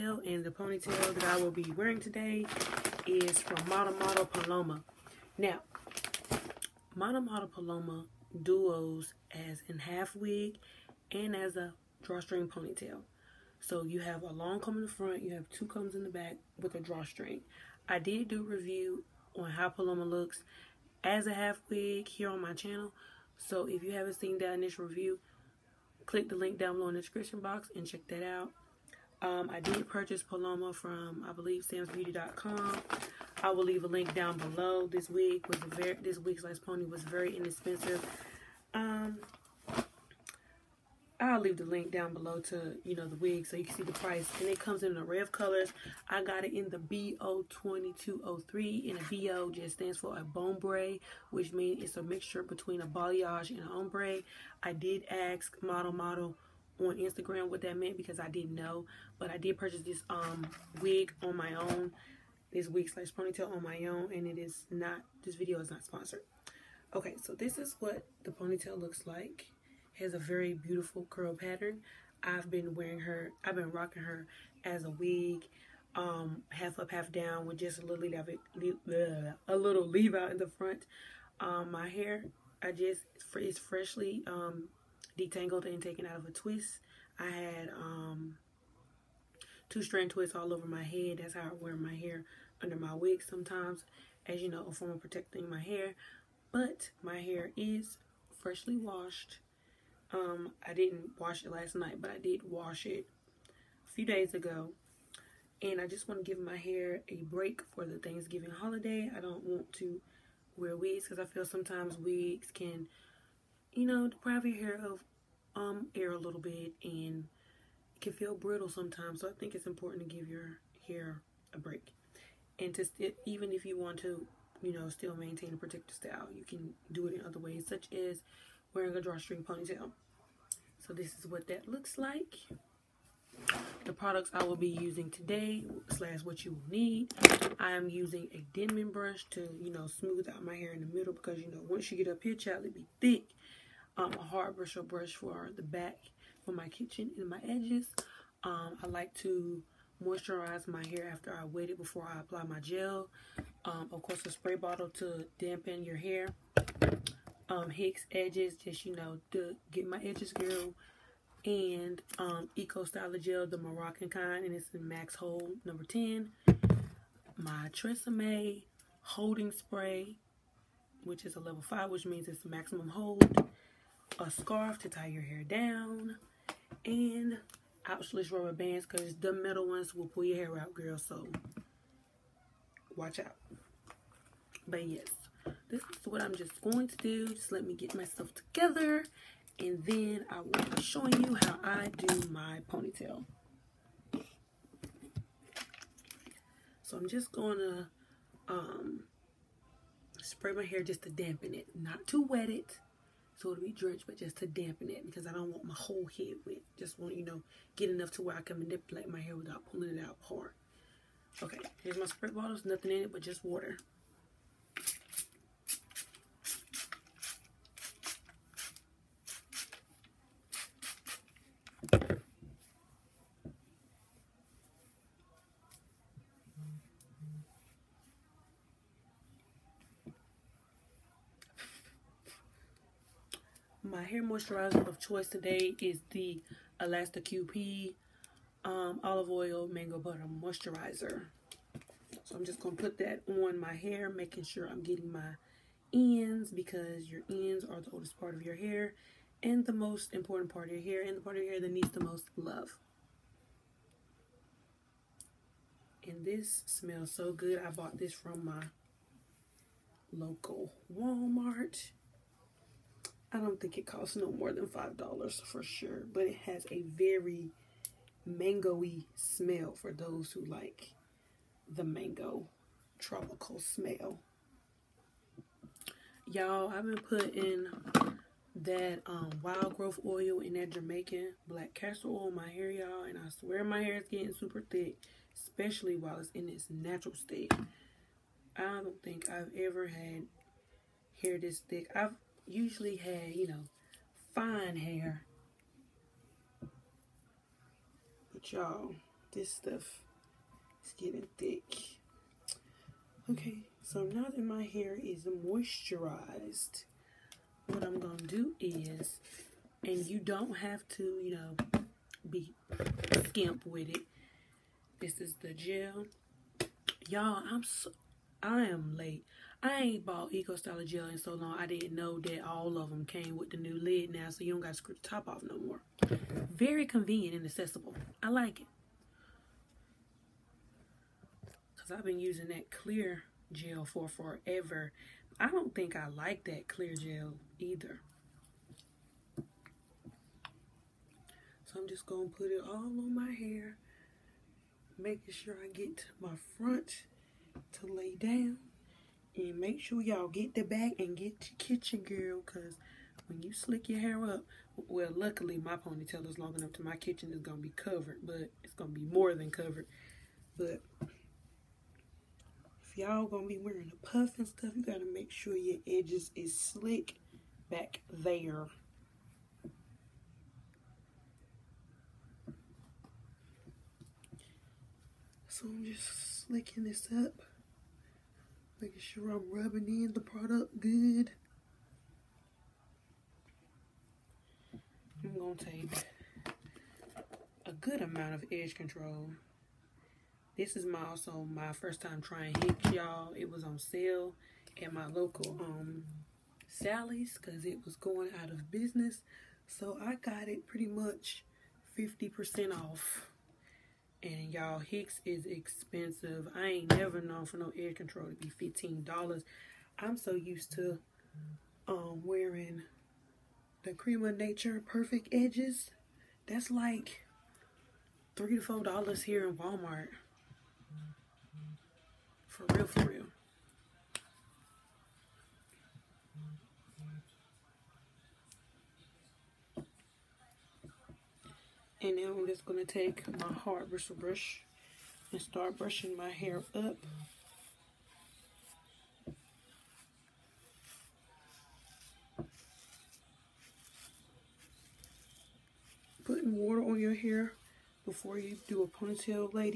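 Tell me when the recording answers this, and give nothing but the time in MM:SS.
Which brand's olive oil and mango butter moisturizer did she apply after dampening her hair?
03:56.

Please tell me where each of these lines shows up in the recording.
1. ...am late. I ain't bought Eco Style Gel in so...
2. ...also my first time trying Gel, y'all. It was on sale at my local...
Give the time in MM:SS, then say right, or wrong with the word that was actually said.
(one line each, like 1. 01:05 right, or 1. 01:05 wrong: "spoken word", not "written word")
1. 05:18 right
2. 06:31 wrong: "Hicks", not "Gel".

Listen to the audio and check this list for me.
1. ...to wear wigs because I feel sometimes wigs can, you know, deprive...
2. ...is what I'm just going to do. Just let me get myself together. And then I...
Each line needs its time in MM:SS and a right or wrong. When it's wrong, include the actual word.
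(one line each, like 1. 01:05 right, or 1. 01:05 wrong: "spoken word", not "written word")
1. 01:49 right
2. 03:05 right.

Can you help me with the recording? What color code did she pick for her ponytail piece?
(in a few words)
BO2203.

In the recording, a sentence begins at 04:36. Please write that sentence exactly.
Y'all, I've been putting that um, wild growth oil and that Jamaican black castor oil in my hair, y'all.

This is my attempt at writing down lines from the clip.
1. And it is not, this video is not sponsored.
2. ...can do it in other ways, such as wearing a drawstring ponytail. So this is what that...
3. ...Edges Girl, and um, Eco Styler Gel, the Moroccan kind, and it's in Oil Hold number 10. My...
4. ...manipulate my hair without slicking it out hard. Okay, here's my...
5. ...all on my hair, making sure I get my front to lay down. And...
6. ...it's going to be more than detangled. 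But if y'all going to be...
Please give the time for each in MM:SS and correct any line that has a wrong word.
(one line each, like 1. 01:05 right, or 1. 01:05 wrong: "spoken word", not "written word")
1. 01:04 right
2. 02:06 right
3. 02:40 wrong: "Max", not "Oil"
4. 03:28 wrong: "pulling", not "slicking"
5. 05:42 right
6. 05:58 wrong: "covered", not "detangled".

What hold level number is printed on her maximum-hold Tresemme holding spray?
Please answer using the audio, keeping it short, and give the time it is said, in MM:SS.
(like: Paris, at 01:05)
5, at 02:51.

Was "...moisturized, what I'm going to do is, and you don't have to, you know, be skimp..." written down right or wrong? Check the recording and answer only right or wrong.
right.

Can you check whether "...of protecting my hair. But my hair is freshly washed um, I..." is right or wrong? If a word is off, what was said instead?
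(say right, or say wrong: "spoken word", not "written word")
right.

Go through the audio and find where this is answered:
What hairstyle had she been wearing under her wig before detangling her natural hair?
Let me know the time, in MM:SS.
01:29.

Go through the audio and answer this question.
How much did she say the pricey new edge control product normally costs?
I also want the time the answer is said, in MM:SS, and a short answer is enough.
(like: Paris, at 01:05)
$15, at 06:48.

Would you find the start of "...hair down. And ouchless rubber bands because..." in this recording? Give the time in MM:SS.
02:55.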